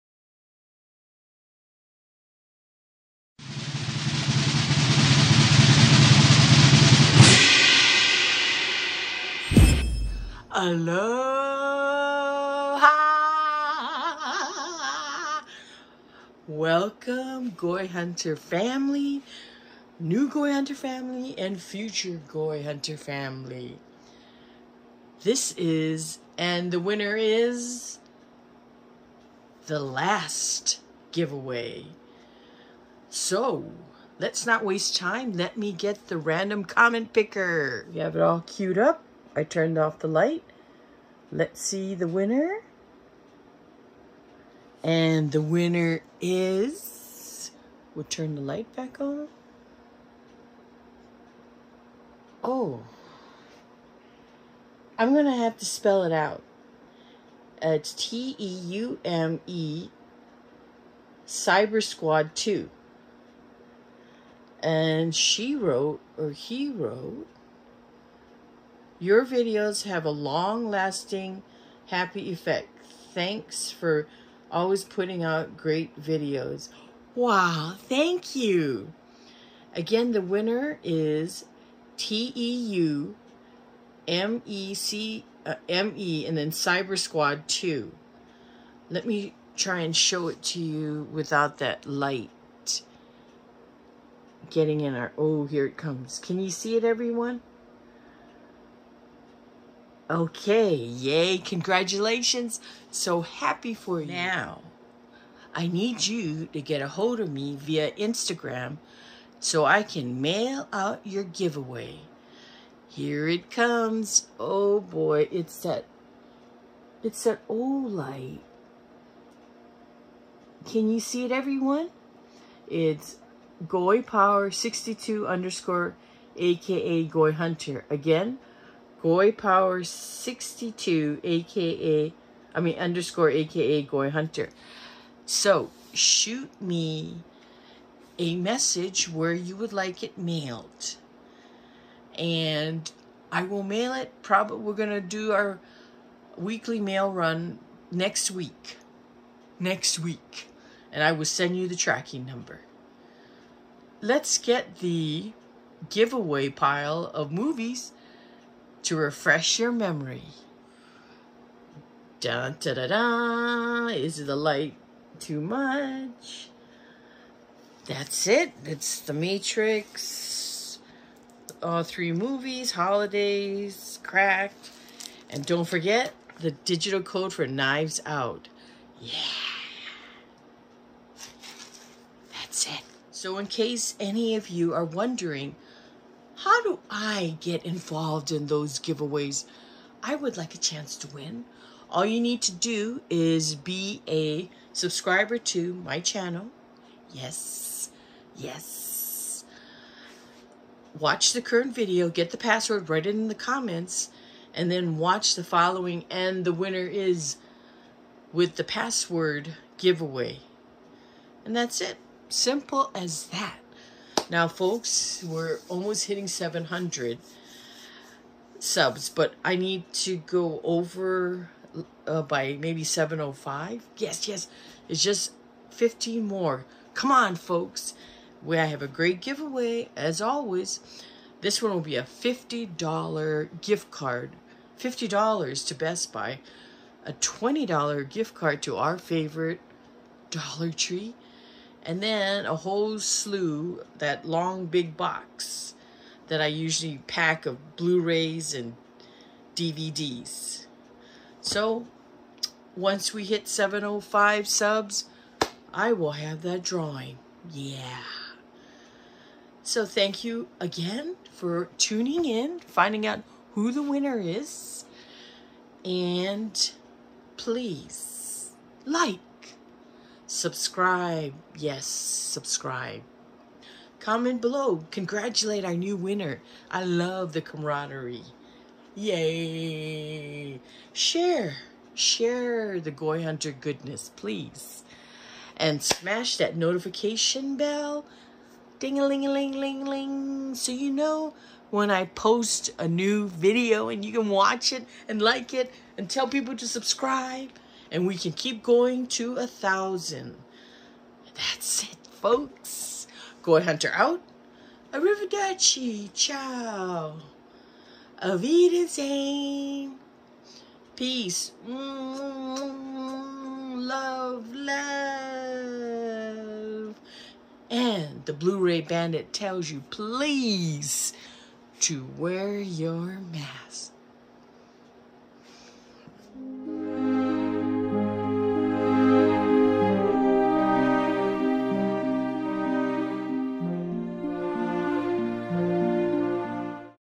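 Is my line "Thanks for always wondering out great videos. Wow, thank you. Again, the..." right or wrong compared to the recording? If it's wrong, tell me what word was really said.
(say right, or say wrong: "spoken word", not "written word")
wrong: "putting", not "wondering".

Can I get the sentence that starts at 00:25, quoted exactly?
This is, and the winner is the last giveaway.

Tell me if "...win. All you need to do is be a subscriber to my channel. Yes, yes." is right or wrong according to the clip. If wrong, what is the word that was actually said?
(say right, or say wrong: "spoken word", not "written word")
right.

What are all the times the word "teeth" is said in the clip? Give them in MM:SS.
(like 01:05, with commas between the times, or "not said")
not said.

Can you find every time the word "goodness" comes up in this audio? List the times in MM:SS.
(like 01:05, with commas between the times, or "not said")
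04:43.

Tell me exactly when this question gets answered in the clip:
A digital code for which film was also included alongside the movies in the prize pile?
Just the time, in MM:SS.
02:57.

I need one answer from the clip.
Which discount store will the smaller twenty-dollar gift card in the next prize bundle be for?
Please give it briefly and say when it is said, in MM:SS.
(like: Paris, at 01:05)
Dollar Tree, at 04:00.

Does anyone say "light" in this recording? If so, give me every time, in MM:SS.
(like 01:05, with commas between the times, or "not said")
00:40, 00:48, 01:31, 01:57, 02:44.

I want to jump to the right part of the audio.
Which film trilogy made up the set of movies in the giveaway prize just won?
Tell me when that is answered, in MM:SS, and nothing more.
02:48.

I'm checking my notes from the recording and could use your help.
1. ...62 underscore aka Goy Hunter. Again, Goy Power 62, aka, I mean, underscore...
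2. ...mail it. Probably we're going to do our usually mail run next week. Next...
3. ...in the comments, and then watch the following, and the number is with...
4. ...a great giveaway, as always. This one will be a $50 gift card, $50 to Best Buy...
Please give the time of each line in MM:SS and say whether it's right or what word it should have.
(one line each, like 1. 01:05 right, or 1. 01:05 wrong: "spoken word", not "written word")
1. 02:04 right
2. 02:23 wrong: "weekly", not "usually"
3. 03:23 wrong: "winner", not "number"
4. 03:48 right.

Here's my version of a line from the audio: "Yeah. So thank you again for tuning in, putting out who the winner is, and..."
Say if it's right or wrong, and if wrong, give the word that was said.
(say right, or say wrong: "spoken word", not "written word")
wrong: "finding", not "putting".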